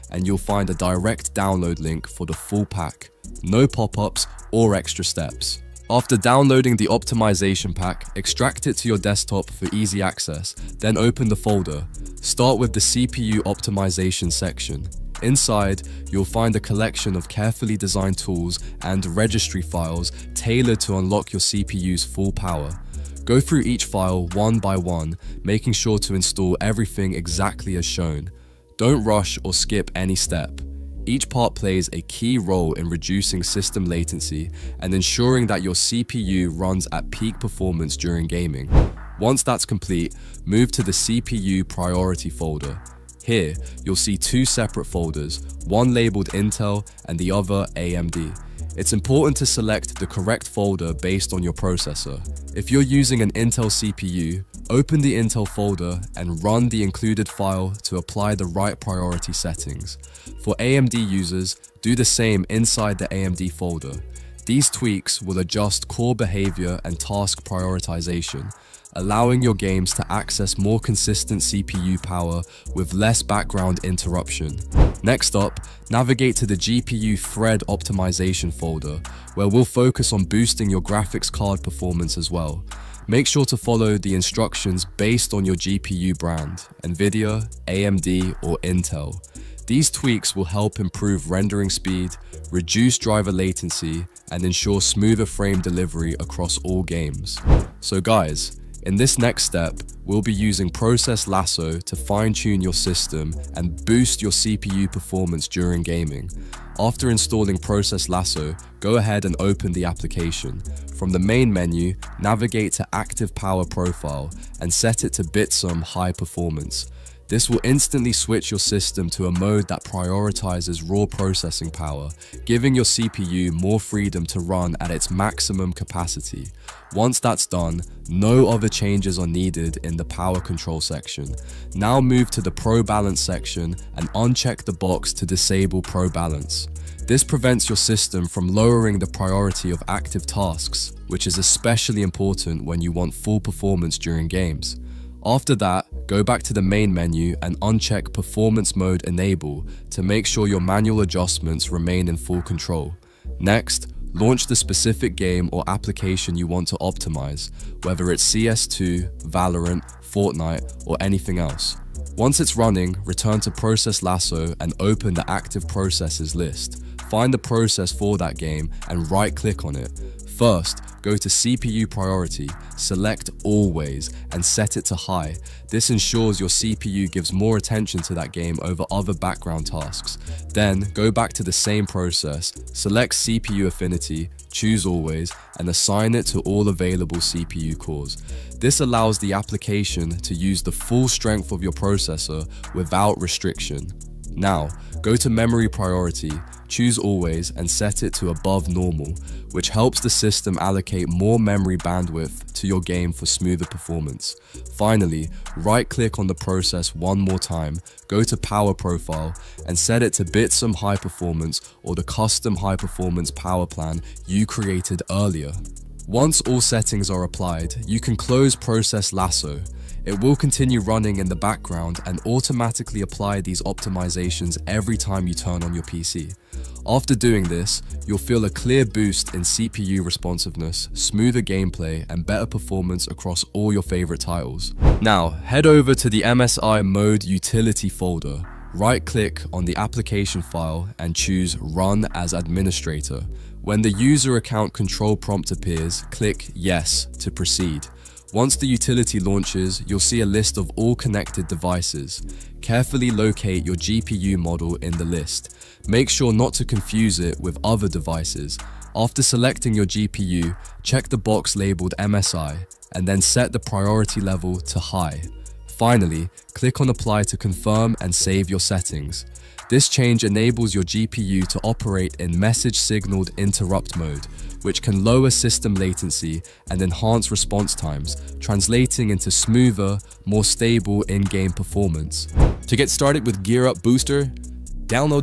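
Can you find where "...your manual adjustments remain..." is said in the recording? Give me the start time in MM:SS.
02:30.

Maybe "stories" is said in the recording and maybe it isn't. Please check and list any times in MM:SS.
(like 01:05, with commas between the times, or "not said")
not said.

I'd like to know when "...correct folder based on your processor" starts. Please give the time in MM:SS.
00:50.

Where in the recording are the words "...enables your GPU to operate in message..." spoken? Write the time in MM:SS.
04:30.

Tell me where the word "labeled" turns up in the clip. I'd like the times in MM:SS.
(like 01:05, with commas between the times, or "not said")
00:45, 04:21.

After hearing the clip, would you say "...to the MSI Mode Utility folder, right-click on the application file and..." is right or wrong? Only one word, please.
right.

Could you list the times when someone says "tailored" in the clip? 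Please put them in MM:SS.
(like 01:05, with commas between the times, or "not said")
00:20.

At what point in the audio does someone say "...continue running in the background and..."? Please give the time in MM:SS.
03:40.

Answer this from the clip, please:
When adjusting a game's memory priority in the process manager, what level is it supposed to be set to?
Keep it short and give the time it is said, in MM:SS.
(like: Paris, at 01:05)
Above normal, at 03:18.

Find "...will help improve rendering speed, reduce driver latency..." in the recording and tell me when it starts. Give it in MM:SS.
01:30.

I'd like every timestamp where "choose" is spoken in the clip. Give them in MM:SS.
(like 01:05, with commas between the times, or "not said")
03:04, 03:16, 04:01.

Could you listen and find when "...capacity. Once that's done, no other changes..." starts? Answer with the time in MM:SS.
02:05.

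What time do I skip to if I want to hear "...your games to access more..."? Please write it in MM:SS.
01:09.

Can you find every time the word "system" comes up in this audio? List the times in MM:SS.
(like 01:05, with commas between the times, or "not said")
00:33, 01:42, 01:58, 02:17, 03:20, 04:35.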